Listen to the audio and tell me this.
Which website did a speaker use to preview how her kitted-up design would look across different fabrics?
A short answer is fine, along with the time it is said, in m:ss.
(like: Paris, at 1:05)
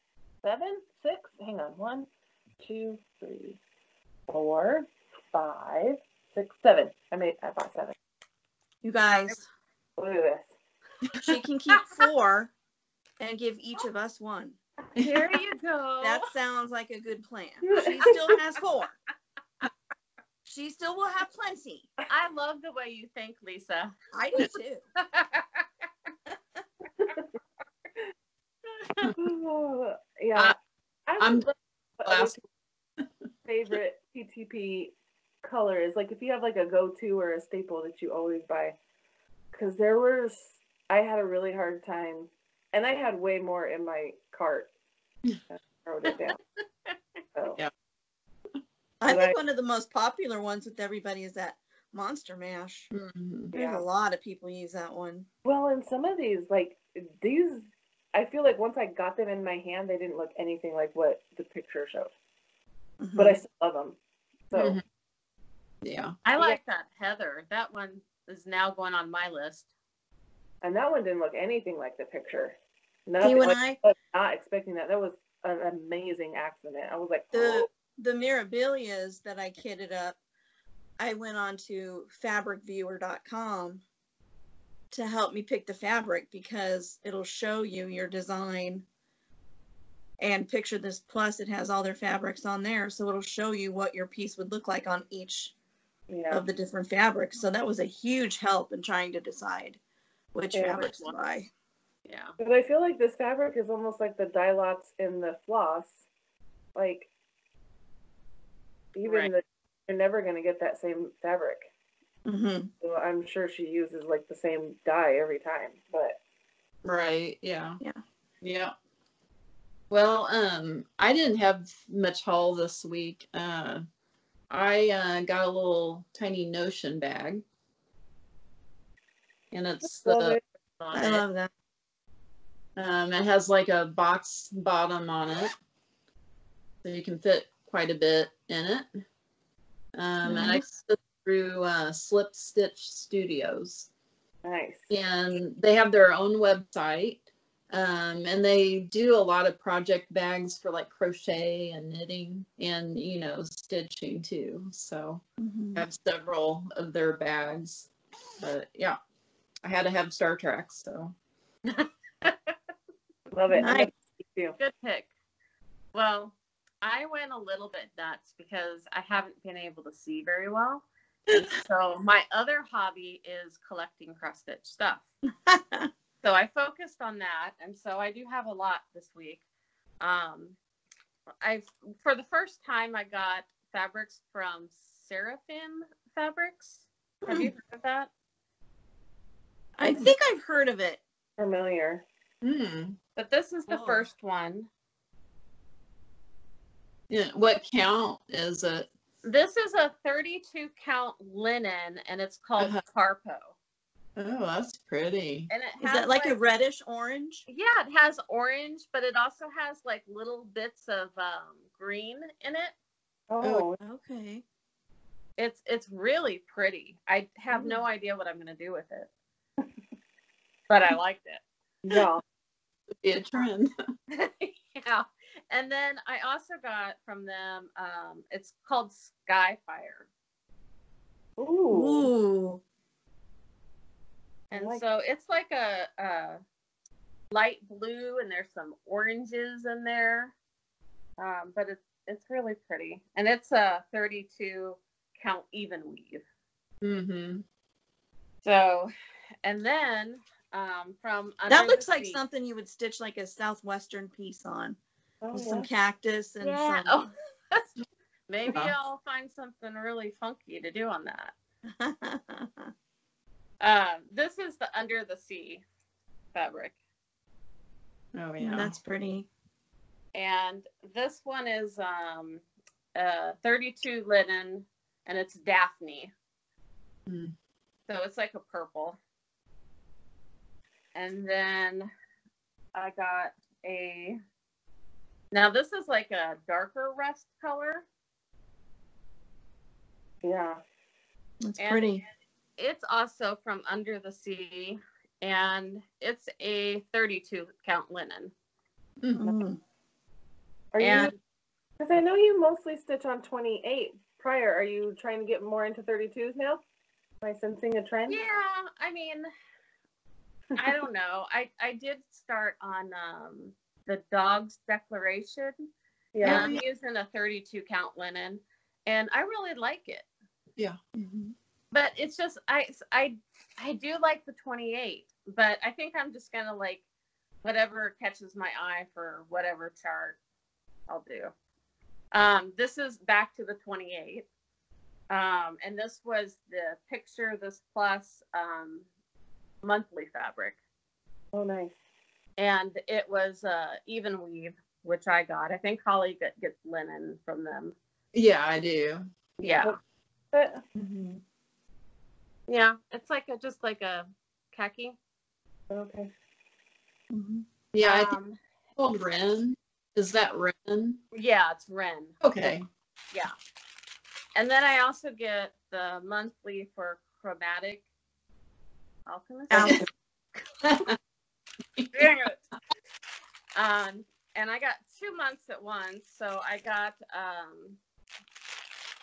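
fabricviewer.com, at 1:22.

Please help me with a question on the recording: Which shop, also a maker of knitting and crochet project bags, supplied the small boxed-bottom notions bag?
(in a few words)
Slipped Stitch Studios.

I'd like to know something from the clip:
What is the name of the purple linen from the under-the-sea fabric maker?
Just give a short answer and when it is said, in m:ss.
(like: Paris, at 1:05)
Daphne, at 4:35.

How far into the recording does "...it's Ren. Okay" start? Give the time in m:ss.
6:01.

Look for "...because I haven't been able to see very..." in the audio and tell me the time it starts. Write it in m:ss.
2:48.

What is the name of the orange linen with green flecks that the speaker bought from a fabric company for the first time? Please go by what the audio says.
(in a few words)
Carpo.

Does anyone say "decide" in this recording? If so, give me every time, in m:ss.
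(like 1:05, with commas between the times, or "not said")
1:39.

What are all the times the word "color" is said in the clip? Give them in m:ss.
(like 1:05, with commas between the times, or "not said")
0:35, 4:47.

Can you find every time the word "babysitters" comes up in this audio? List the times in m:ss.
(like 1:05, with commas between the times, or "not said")
not said.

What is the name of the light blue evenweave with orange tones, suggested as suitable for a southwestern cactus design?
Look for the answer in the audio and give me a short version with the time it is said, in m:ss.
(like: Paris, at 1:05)
Skyfire, at 3:48.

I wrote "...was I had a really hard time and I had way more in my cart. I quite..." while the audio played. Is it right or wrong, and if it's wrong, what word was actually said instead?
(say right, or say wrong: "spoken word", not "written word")
wrong: "wrote", not "quite".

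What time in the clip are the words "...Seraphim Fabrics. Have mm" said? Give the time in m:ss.
3:05.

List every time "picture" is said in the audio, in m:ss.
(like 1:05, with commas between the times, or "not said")
1:01, 1:12, 1:30, 5:36.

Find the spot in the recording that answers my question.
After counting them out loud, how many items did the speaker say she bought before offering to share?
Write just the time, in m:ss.
0:07.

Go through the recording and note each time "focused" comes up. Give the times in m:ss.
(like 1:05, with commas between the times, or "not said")
2:56.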